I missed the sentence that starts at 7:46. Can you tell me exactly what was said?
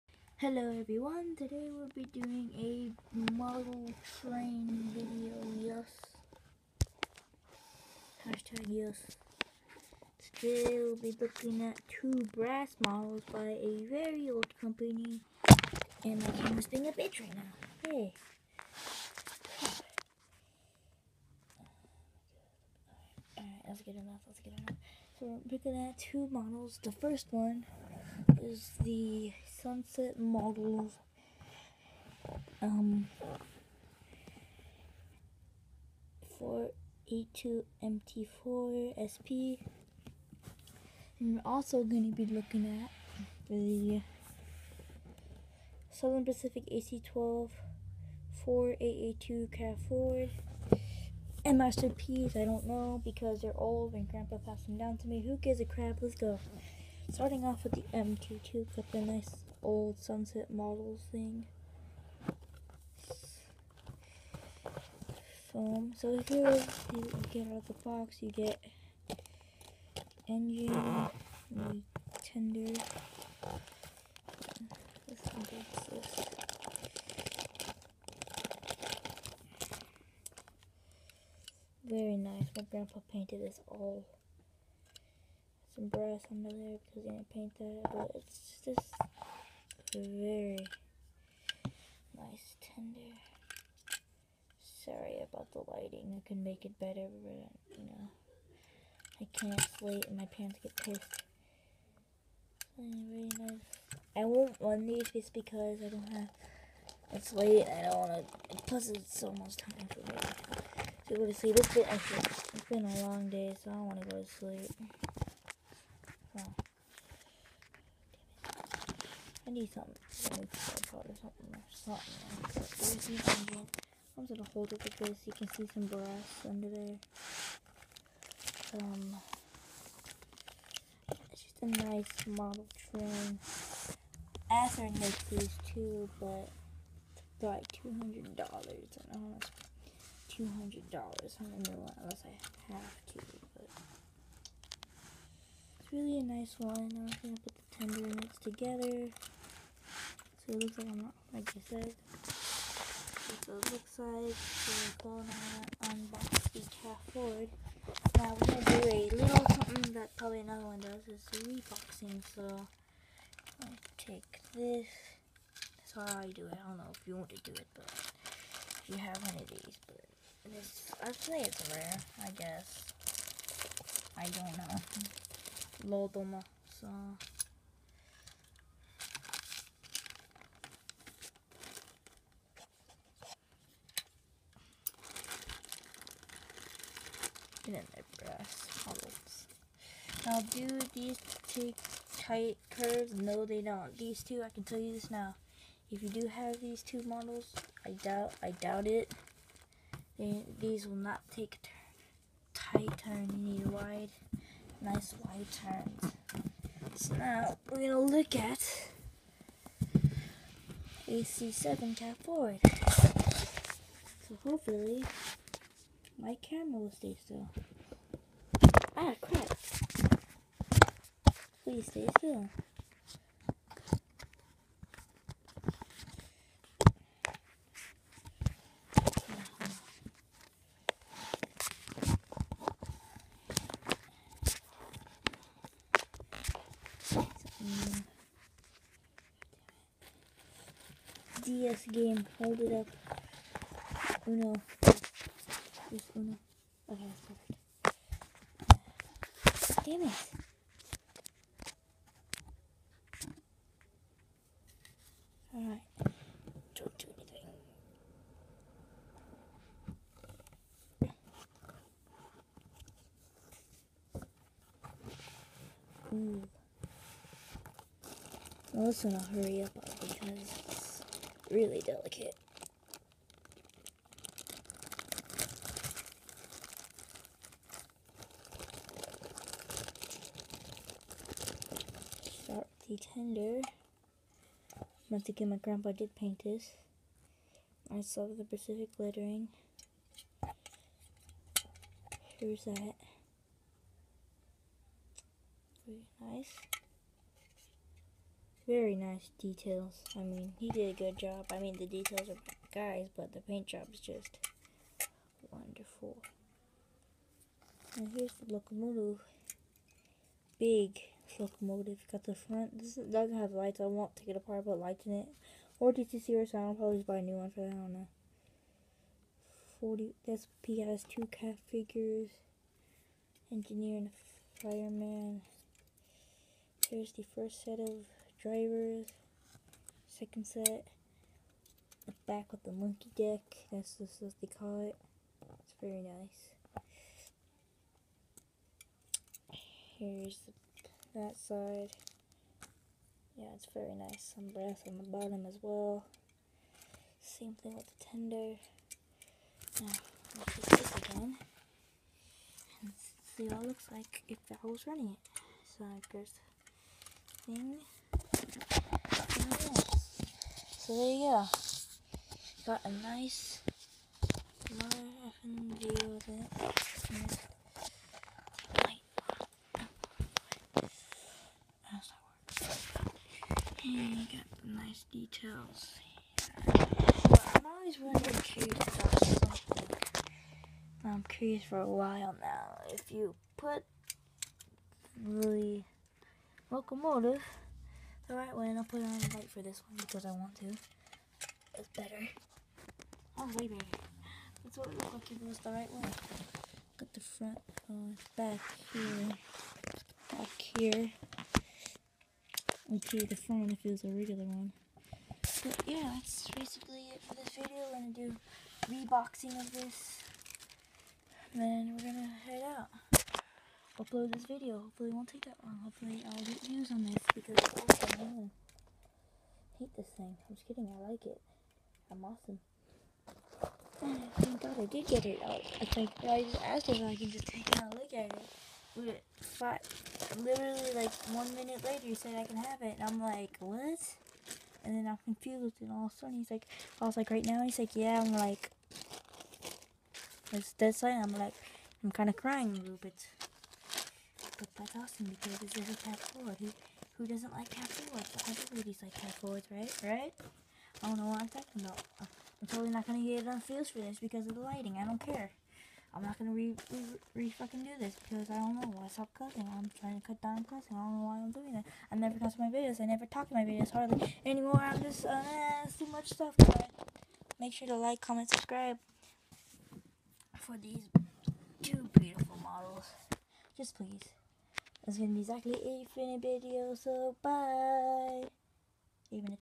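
But make sure to like, comment, subscribe for these two beautiful models.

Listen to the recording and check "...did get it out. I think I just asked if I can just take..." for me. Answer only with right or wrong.
right.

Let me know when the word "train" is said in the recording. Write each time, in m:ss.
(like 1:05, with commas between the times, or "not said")
0:04, 2:12.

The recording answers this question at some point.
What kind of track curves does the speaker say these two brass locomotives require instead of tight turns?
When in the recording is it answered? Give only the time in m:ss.
3:24.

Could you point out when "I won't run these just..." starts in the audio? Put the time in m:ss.
1:44.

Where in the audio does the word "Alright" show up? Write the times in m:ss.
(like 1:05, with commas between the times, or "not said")
0:23, 4:15.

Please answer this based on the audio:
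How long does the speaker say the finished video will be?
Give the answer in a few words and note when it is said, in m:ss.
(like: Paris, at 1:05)
8 minutes, at 7:55.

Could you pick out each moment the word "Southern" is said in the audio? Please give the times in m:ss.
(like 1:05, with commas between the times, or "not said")
0:45.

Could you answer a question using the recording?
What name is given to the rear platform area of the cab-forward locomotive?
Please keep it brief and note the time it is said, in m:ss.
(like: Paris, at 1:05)
Monkey deck, at 5:32.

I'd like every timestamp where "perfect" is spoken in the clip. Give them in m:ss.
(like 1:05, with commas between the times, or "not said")
4:07.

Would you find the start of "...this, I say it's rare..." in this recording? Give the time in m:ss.
2:50.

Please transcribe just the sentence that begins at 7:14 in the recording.
And then I'm confused, and all of a sudden he's like, I was like, right now?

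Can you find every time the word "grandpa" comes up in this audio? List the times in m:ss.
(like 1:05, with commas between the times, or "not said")
0:54, 1:22, 4:45.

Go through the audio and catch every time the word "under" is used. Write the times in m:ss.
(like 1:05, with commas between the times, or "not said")
1:26, 2:06.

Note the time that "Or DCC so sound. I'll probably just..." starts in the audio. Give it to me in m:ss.
5:15.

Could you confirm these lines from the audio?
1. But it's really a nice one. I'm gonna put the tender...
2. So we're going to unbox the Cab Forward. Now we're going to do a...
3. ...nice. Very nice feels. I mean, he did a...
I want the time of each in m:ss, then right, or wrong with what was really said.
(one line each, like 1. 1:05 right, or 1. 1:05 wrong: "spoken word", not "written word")
1. 2:23 right
2. 2:34 right
3. 4:56 wrong: "details", not "feels".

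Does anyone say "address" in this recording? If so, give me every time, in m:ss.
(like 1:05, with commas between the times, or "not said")
not said.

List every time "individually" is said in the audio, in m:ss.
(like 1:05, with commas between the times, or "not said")
not said.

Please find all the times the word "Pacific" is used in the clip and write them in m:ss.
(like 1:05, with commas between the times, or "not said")
0:46, 4:48.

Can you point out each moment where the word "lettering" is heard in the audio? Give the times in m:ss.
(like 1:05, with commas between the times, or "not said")
4:48.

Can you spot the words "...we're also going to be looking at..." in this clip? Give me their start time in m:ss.
0:41.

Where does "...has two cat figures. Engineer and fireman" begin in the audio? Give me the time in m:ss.
5:20.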